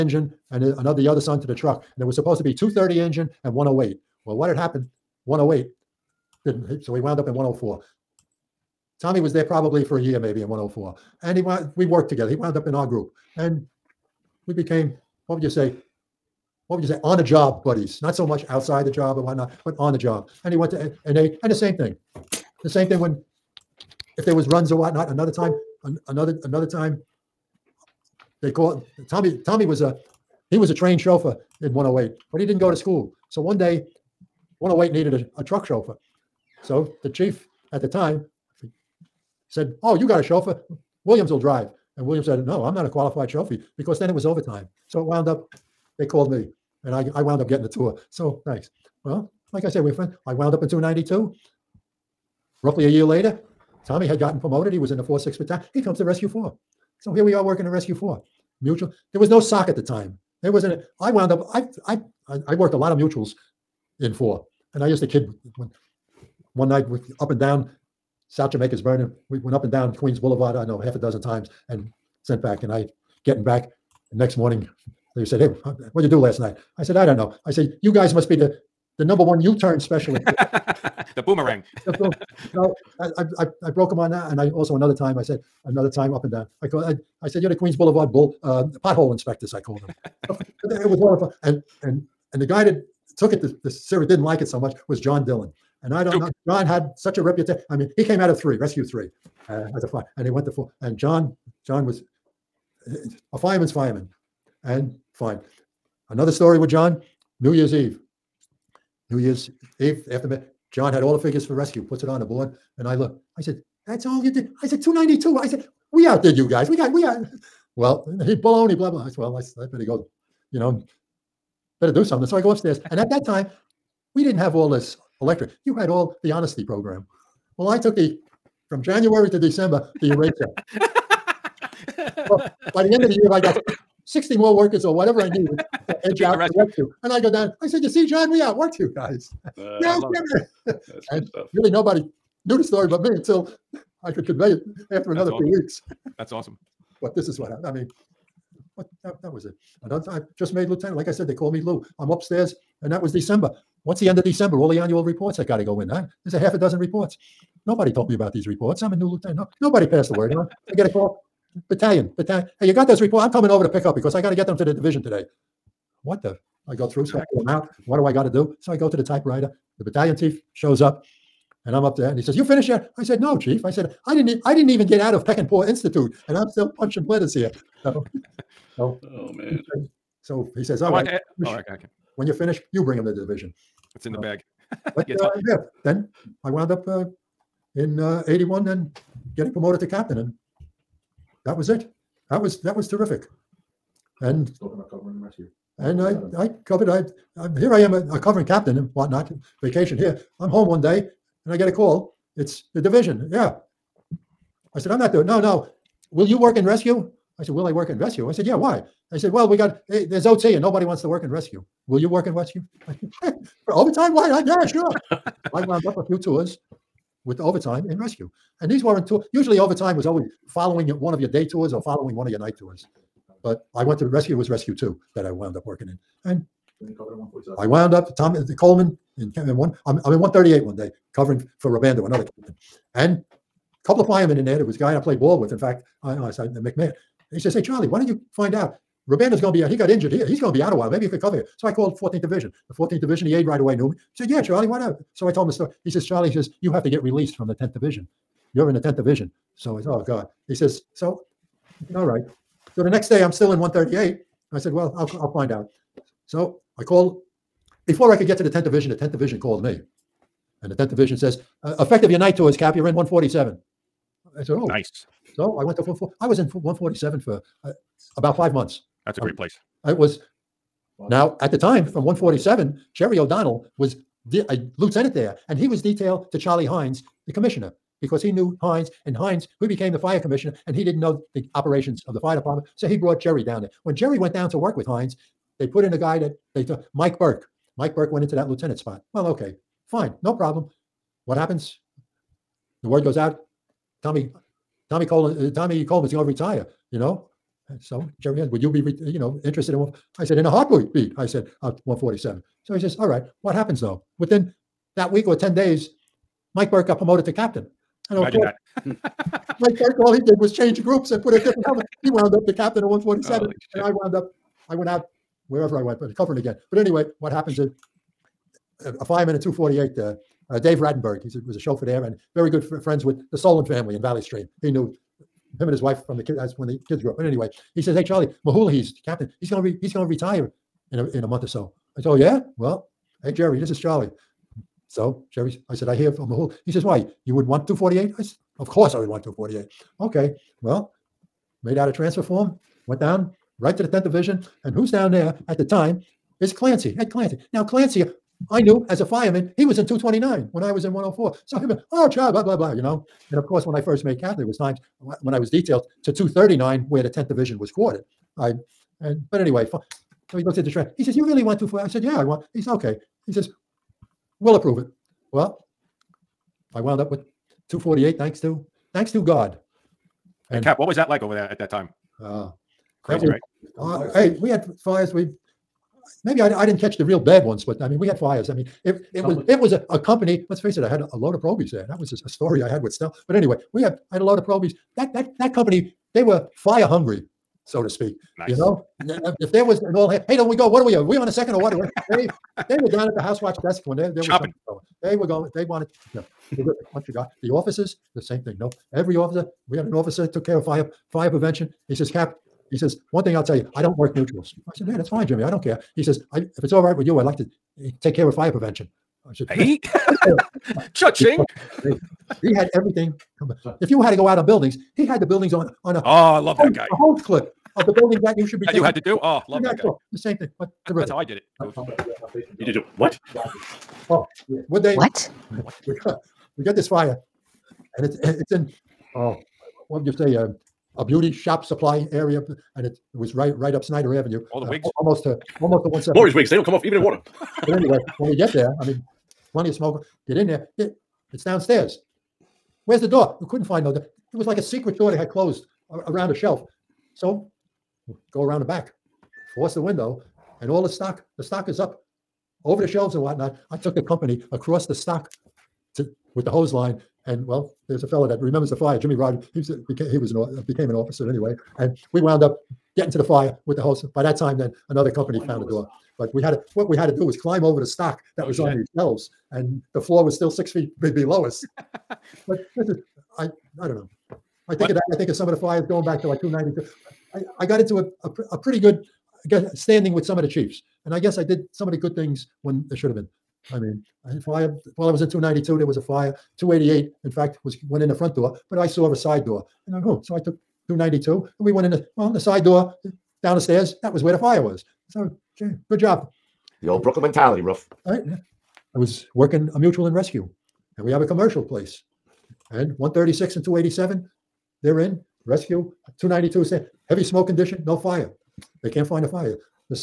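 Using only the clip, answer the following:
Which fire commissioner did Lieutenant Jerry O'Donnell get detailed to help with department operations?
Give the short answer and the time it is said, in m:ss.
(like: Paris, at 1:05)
Charlie Hines, at 4:36.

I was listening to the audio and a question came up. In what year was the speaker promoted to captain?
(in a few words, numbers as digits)
1981.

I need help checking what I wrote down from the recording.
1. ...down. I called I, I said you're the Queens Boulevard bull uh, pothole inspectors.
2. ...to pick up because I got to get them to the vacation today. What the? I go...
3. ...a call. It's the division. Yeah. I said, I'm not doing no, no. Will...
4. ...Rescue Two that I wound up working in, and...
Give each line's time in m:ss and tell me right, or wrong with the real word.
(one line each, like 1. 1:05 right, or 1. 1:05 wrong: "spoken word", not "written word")
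1. 1:26 right
2. 2:43 wrong: "division", not "vacation"
3. 3:21 right
4. 3:44 right.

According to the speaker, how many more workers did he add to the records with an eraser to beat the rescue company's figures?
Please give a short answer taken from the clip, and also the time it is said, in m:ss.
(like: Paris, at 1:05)
60, at 2:14.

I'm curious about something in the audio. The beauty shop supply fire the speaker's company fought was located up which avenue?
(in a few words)
Snyder Avenue.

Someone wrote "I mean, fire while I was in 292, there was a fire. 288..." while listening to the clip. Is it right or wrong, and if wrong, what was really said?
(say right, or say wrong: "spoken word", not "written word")
right.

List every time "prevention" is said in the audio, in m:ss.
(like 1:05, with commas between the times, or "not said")
6:41, 6:48.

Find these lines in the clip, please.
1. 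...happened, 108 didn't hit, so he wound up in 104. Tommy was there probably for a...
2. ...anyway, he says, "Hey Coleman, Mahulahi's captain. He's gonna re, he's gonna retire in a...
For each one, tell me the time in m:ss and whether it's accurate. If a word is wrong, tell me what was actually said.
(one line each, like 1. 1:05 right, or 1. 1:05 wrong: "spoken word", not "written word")
1. 0:04 right
2. 5:27 wrong: "Charlie", not "Coleman".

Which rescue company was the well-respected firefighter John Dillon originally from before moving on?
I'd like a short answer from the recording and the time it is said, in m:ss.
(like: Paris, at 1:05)
Rescue 3, at 1:38.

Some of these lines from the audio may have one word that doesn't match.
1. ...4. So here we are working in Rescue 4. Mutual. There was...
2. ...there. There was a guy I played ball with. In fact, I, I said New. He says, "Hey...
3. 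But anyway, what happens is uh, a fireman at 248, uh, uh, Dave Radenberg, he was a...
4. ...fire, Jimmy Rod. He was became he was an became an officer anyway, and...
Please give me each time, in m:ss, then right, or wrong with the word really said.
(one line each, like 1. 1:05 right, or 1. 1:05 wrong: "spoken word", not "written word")
1. 0:56 right
2. 3:54 wrong: "McMahon", not "New"
3. 5:16 right
4. 7:38 right.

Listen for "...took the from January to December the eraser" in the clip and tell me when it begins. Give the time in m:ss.
2:07.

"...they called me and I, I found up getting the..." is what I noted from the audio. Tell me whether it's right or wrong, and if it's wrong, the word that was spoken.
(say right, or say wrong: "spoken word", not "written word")
wrong: "wound", not "found".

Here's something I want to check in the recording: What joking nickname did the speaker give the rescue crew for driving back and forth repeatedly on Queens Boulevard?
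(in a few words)
U-turn specialist.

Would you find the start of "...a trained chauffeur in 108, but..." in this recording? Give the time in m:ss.
0:30.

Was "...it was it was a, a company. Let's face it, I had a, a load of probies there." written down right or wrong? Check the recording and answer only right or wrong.
right.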